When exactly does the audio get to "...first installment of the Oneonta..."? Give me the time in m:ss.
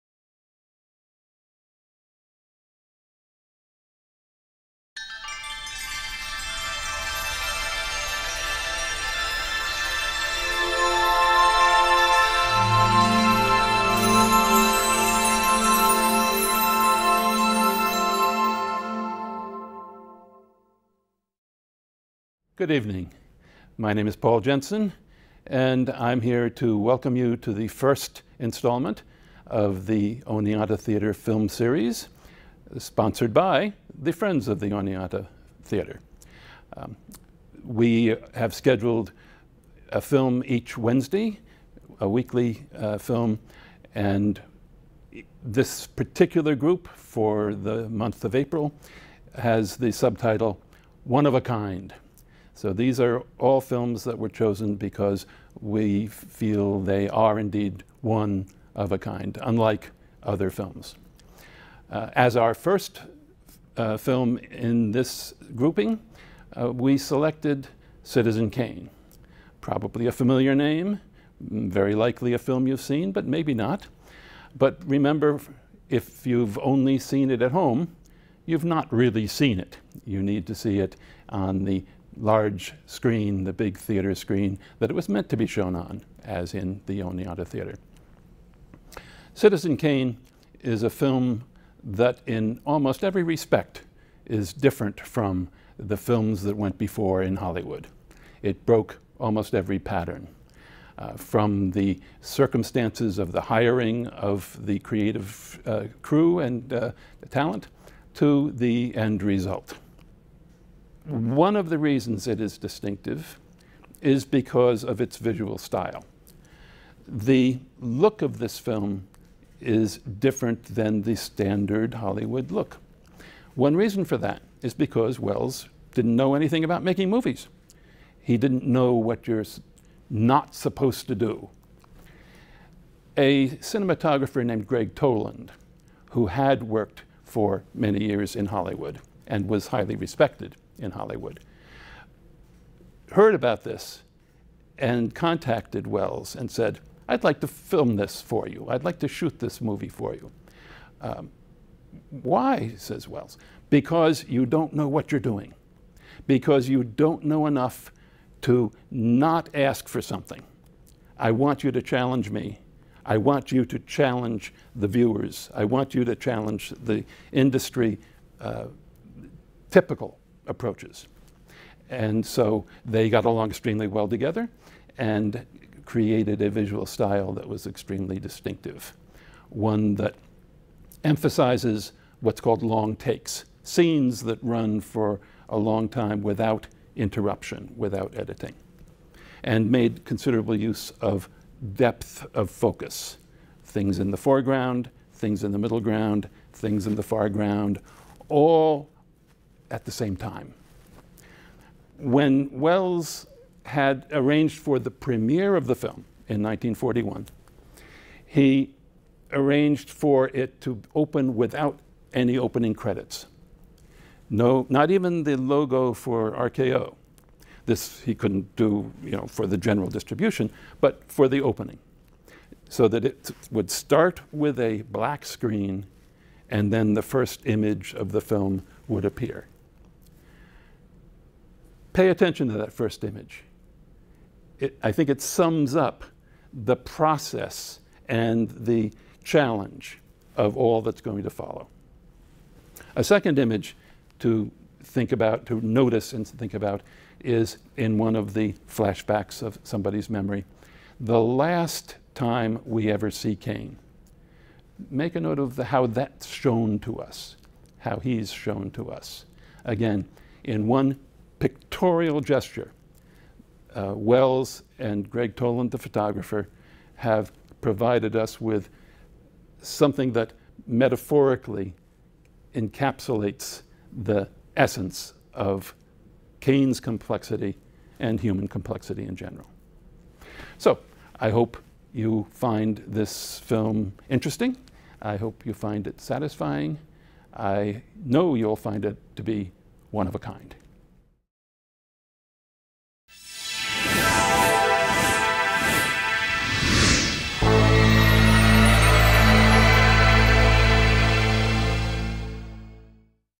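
0:27.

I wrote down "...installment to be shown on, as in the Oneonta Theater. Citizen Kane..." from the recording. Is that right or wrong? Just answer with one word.
wrong.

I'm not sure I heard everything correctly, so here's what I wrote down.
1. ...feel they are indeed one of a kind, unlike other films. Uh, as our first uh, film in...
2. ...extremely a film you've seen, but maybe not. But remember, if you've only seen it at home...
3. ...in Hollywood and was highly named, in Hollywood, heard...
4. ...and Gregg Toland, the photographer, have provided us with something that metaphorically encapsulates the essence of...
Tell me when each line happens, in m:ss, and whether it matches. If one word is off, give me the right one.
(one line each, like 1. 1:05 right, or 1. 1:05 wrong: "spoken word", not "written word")
1. 0:56 right
2. 1:11 wrong: "likely", not "extremely"
3. 2:18 wrong: "respected", not "named"
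4. 4:24 right.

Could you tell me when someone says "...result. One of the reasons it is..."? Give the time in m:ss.
1:49.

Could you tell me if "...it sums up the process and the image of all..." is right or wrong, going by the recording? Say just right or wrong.
wrong.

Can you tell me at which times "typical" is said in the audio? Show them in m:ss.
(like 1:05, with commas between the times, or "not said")
2:49.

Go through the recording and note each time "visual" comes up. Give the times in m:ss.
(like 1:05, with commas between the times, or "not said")
1:55, 2:56.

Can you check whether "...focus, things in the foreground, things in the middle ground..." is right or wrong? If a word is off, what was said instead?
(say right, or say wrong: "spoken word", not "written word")
right.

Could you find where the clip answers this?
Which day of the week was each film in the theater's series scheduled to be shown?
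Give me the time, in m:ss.
0:40.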